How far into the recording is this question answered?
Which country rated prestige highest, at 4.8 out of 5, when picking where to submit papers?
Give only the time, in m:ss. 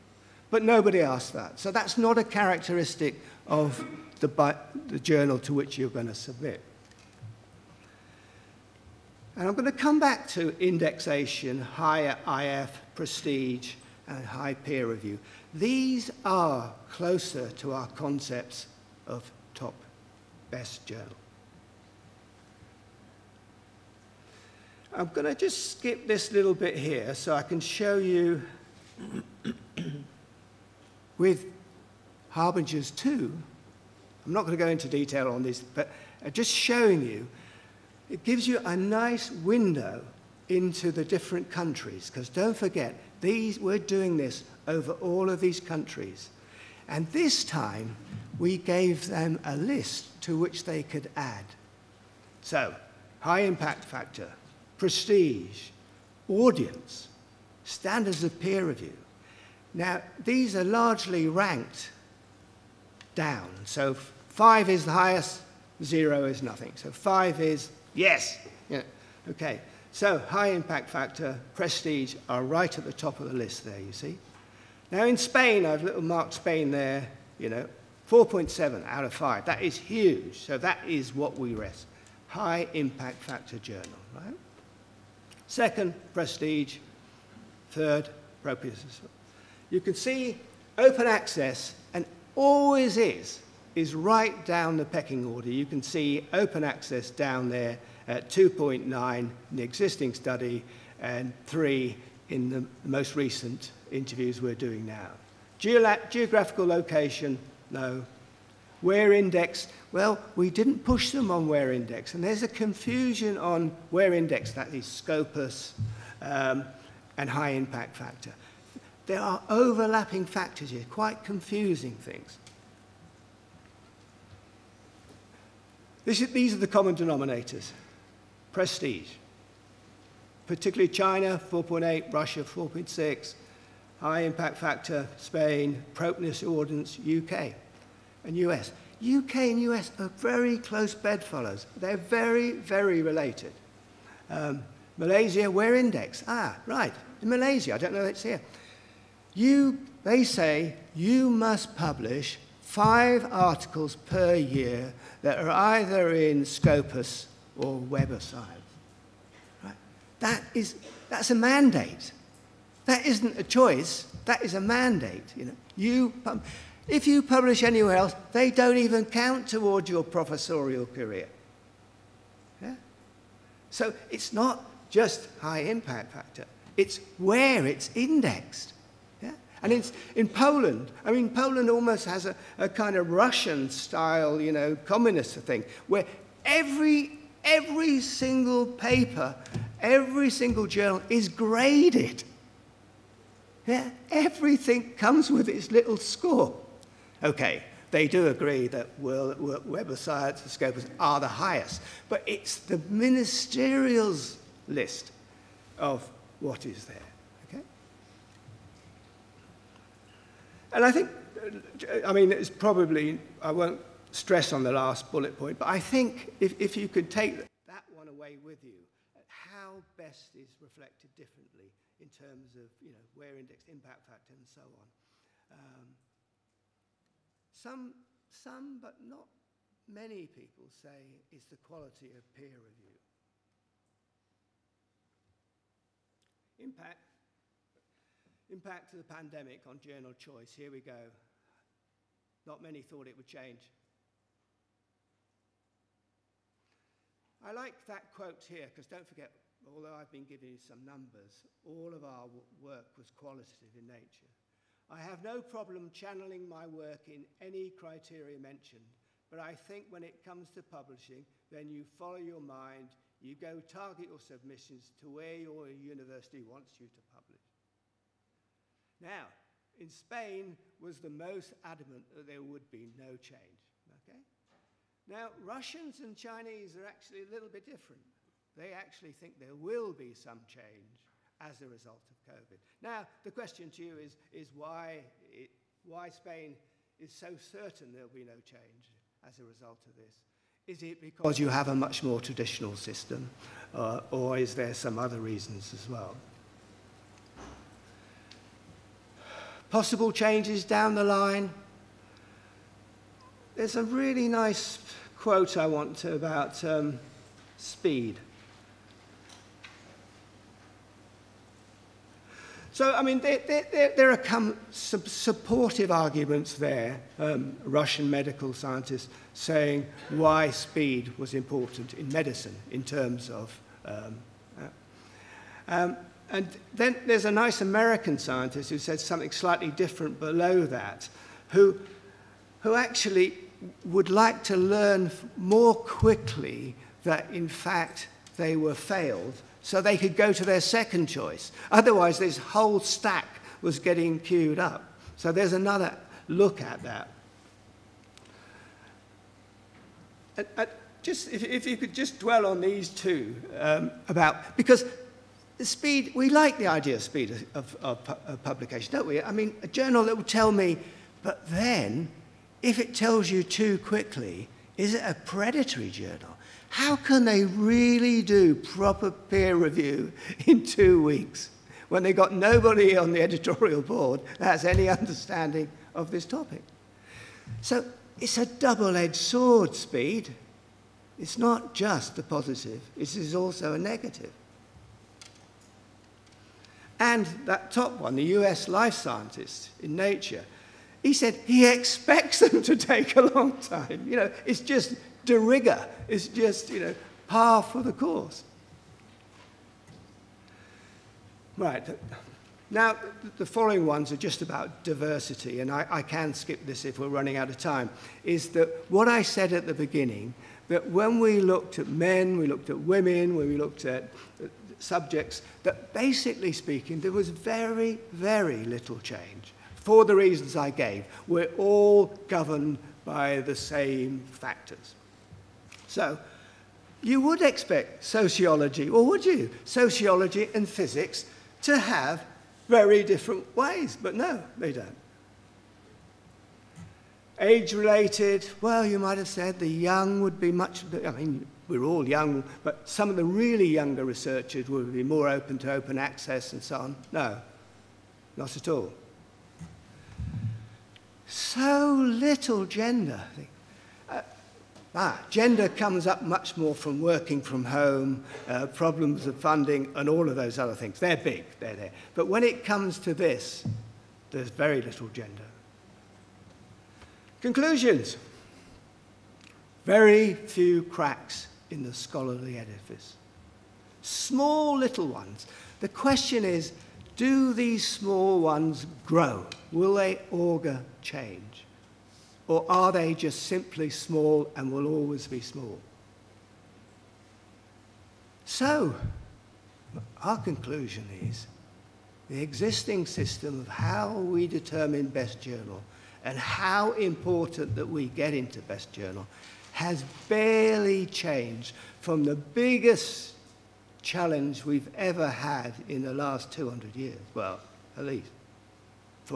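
2:10.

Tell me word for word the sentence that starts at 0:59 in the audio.
Now, these are largely ranked down.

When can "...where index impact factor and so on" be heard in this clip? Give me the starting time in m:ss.
3:43.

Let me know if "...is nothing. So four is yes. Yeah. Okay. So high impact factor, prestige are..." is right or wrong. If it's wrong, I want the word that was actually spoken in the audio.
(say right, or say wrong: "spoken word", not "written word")
wrong: "five", not "four".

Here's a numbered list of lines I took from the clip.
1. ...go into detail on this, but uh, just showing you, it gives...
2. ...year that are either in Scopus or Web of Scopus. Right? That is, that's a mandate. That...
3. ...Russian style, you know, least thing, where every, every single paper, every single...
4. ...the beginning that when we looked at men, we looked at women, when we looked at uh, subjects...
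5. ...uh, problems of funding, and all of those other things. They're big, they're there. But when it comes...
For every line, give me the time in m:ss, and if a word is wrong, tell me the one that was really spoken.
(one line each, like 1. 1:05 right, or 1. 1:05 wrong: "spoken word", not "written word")
1. 0:34 right
2. 2:34 wrong: "Science", not "Scopus"
3. 3:03 wrong: "communist", not "least"
4. 6:49 right
5. 7:38 right.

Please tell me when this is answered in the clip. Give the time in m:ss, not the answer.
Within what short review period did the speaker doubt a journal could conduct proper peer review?
6:10.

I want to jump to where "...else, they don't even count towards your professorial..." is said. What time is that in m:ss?
2:47.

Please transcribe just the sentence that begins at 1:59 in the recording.
There are overlapping factors here, quite confusing things.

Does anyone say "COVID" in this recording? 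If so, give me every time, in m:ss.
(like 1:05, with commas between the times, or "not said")
4:42.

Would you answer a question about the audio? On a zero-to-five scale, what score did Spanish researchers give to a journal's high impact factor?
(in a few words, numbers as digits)
4.7.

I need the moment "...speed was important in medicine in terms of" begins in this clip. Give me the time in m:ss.
5:20.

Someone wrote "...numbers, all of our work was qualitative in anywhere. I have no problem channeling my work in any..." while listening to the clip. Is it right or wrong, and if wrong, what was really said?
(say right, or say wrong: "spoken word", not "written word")
wrong: "nature", not "anywhere".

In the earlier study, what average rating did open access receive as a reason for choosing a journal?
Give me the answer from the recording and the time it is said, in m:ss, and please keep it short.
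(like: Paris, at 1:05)
2.9, at 1:38.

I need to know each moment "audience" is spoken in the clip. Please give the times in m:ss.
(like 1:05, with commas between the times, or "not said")
0:56, 2:16.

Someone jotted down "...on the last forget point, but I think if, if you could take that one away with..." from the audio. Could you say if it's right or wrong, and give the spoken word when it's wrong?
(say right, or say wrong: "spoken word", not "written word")
wrong: "bullet", not "forget".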